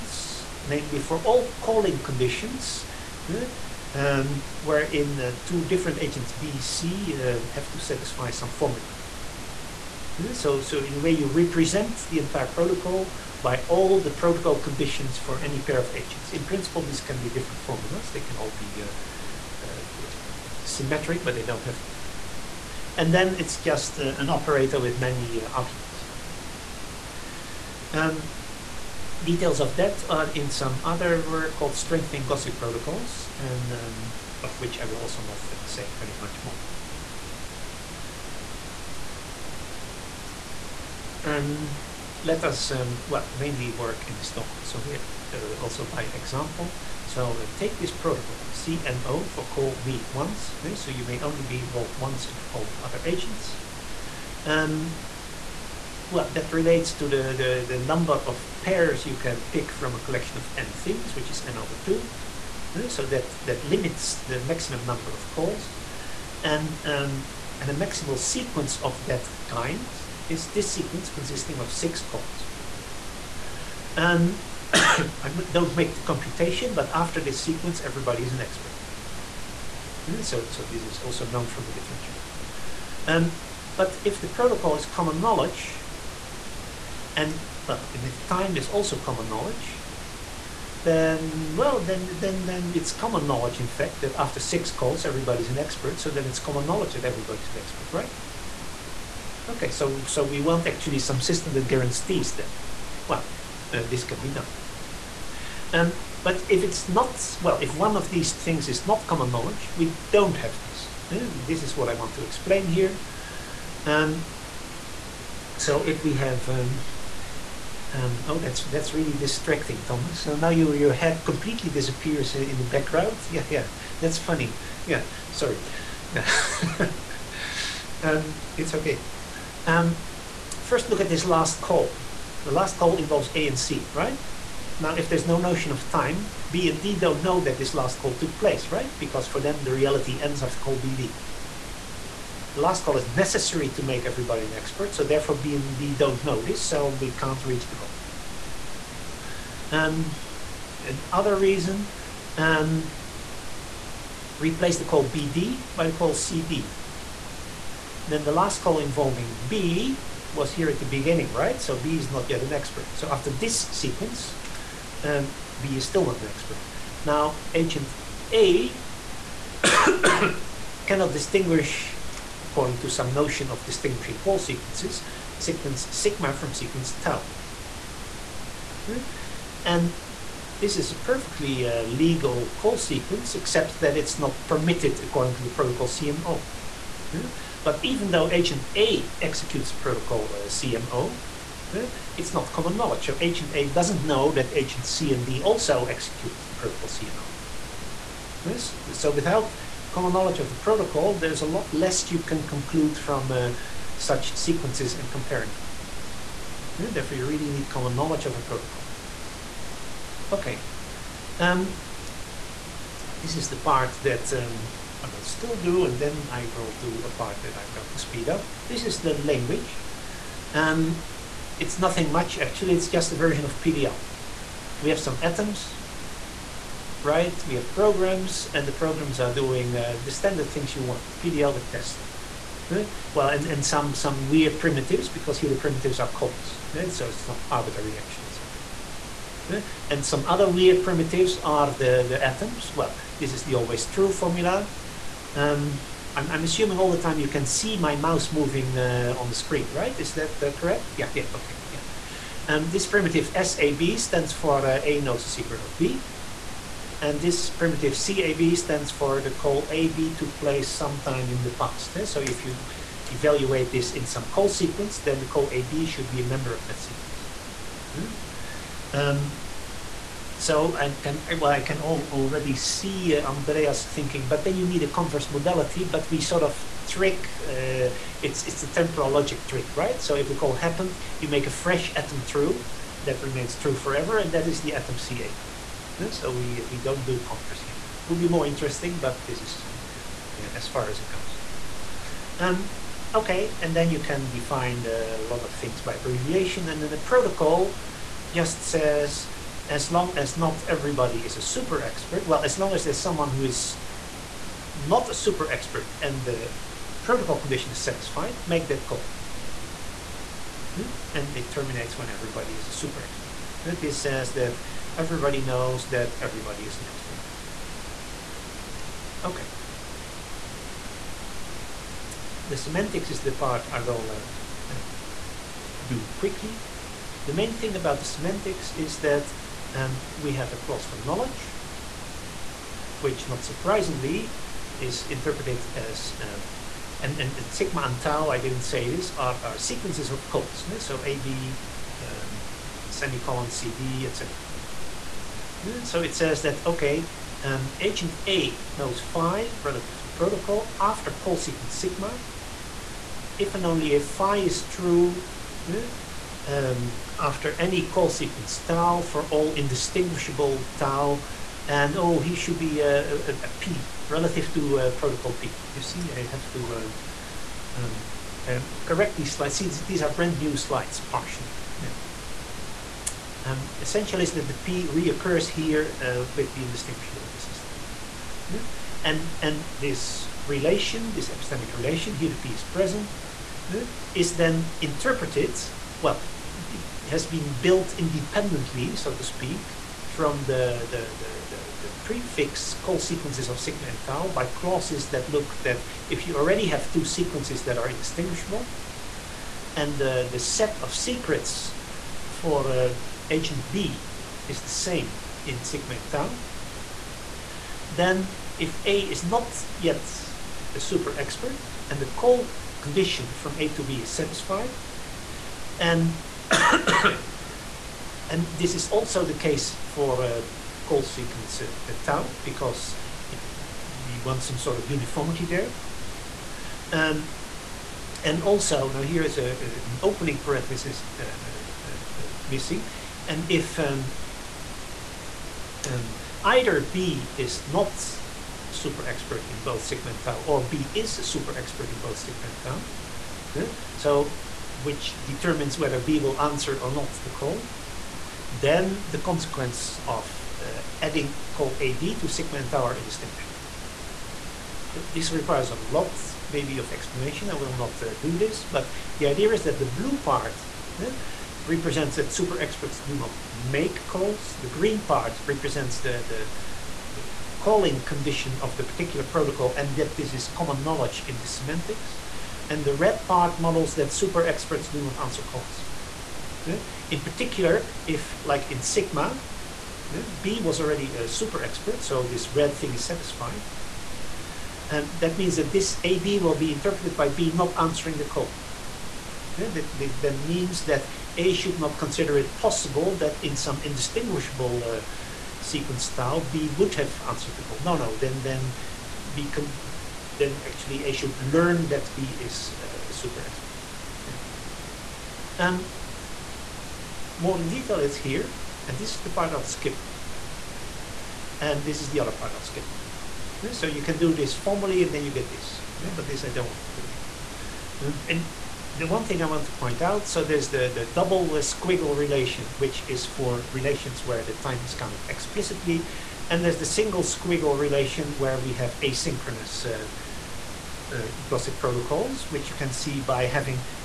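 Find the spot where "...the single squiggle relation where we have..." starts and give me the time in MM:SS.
08:46.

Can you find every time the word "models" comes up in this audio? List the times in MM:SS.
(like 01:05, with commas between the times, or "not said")
07:53.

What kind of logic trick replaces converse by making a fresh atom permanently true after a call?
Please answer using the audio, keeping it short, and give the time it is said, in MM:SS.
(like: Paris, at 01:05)
temporal logic trick, at 04:38.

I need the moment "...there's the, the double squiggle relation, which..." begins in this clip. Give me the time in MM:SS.
08:40.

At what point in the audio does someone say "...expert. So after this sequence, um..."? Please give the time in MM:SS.
02:42.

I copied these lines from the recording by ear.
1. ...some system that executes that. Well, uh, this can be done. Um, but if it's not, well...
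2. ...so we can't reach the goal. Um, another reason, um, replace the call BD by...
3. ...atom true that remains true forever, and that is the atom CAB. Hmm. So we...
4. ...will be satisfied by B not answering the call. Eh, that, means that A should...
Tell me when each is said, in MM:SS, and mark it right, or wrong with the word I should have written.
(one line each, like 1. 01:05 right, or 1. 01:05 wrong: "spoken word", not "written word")
1. 01:40 wrong: "guarantees", not "executes"
2. 02:26 right
3. 04:41 right
4. 08:06 wrong: "interpreted", not "satisfied".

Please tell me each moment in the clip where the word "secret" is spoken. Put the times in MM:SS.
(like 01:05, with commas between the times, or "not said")
04:15, 06:40.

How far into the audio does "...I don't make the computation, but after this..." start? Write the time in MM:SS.
01:14.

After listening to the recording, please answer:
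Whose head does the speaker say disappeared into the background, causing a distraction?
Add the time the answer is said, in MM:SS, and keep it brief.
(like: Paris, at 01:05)
Thomas, at 01:59.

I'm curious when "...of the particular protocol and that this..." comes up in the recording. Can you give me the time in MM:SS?
07:48.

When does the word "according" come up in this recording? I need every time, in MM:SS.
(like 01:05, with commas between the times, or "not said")
02:52, 03:05.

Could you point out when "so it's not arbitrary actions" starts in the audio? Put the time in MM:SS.
03:56.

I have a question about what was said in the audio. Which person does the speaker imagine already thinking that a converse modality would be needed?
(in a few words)
Andreas.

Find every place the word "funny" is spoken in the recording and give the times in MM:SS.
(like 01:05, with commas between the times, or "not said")
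02:04.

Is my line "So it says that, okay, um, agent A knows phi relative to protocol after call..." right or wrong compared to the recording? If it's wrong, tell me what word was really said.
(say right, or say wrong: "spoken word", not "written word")
right.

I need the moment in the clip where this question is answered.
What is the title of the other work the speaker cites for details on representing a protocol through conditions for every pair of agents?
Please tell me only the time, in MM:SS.
00:31.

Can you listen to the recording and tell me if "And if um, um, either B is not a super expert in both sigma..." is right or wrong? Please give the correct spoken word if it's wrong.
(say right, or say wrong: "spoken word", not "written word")
right.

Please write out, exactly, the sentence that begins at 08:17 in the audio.
No, no, then, then we can then actually I should learn that B is uh, a super expert.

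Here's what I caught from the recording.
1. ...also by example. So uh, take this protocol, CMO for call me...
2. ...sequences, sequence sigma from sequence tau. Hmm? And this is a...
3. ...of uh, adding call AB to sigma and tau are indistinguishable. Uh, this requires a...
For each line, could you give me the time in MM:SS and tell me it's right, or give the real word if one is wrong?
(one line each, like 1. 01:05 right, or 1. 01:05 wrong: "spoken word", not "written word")
1. 00:45 right
2. 02:54 right
3. 07:30 right.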